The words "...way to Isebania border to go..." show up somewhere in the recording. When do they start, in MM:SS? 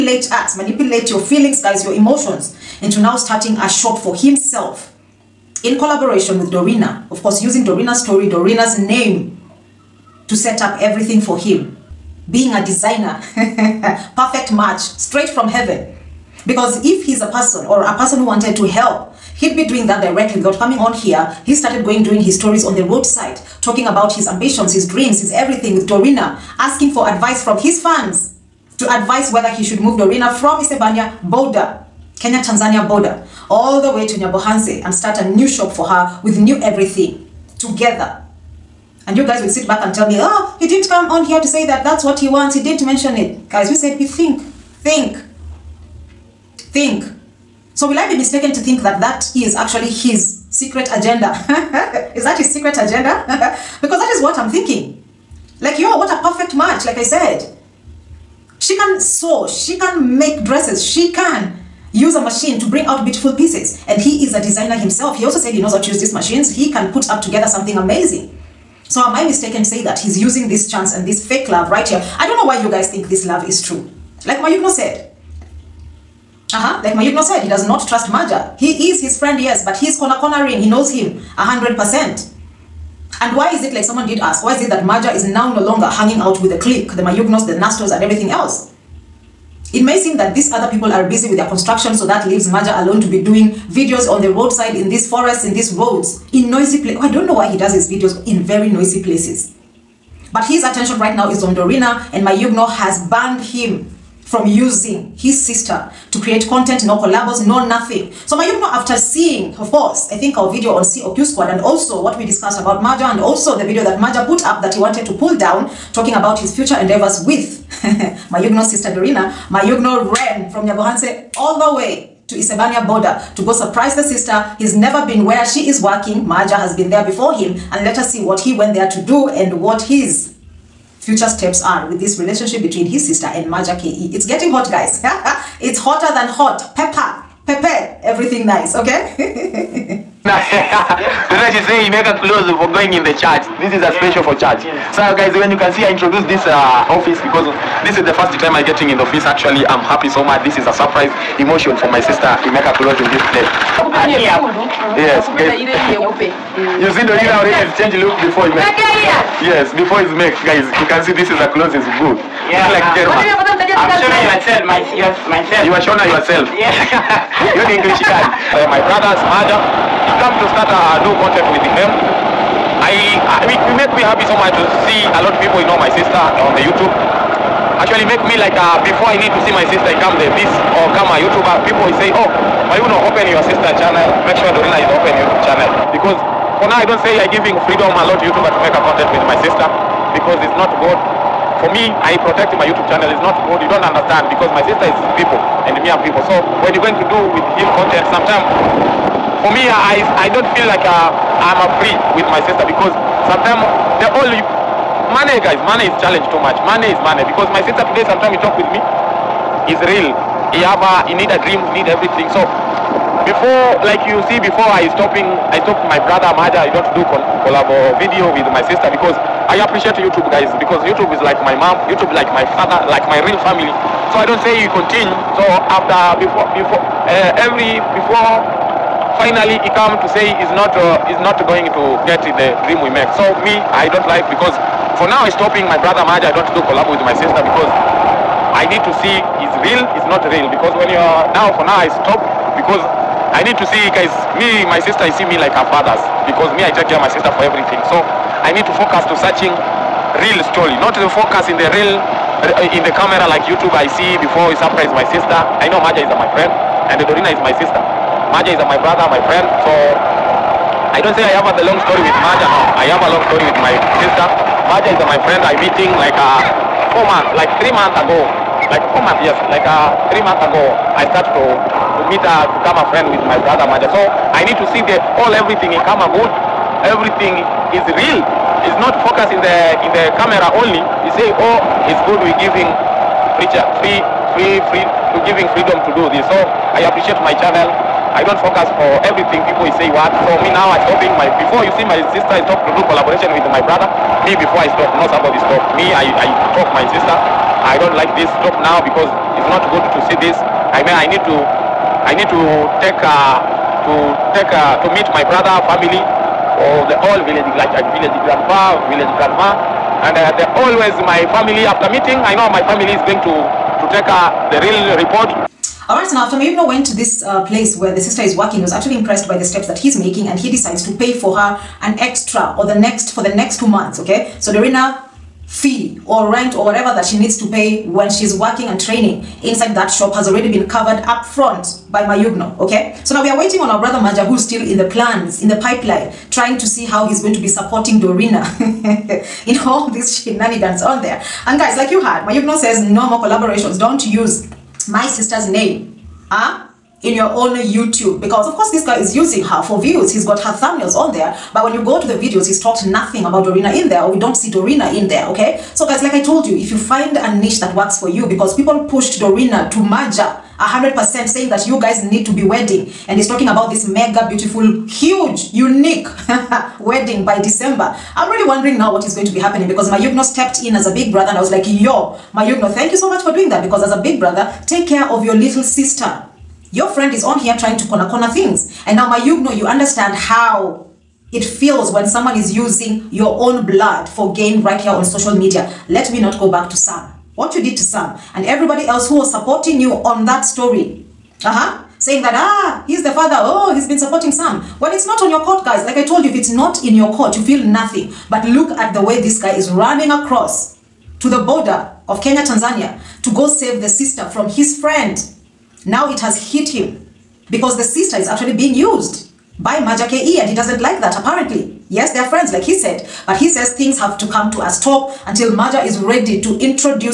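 02:01.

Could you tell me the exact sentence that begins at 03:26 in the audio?
Money is money because my sister today sometimes he talk with me is real.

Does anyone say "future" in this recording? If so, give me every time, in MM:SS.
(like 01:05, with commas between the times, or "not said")
01:56, 02:10.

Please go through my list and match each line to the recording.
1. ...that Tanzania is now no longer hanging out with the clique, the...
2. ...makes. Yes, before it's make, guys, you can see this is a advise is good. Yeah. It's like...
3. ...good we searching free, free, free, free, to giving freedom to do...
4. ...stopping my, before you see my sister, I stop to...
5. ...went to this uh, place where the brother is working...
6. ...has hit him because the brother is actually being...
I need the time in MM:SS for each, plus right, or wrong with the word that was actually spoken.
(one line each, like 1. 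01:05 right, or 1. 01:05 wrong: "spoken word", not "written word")
1. 01:24 wrong: "Maja", not "Tanzania"
2. 02:38 wrong: "close", not "advise"
3. 04:42 wrong: "giving", not "searching"
4. 04:50 right
5. 05:16 wrong: "sister", not "brother"
6. 06:46 wrong: "sister", not "brother".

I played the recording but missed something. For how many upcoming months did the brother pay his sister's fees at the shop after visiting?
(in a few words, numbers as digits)
2.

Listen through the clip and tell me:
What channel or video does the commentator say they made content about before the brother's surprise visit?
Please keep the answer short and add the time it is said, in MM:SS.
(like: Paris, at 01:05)
COQ Squad, at 01:50.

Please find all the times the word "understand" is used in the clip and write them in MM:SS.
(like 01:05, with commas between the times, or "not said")
03:13, 06:19.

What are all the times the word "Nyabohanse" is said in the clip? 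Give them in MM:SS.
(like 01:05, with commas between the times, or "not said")
00:34, 02:00.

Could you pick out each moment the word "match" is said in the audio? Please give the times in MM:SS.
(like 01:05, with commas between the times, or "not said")
00:14, 00:56.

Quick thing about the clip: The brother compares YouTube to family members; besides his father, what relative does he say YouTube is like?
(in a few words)
mom.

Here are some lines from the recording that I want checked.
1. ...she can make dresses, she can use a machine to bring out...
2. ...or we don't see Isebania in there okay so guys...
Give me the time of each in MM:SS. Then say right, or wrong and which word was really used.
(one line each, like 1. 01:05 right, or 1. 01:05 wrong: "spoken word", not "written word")
1. 00:59 right
2. 05:54 wrong: "Dorina", not "Isebania".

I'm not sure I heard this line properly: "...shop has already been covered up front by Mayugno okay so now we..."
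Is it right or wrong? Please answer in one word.
right.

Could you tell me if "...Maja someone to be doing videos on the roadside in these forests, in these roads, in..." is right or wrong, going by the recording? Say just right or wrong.
wrong.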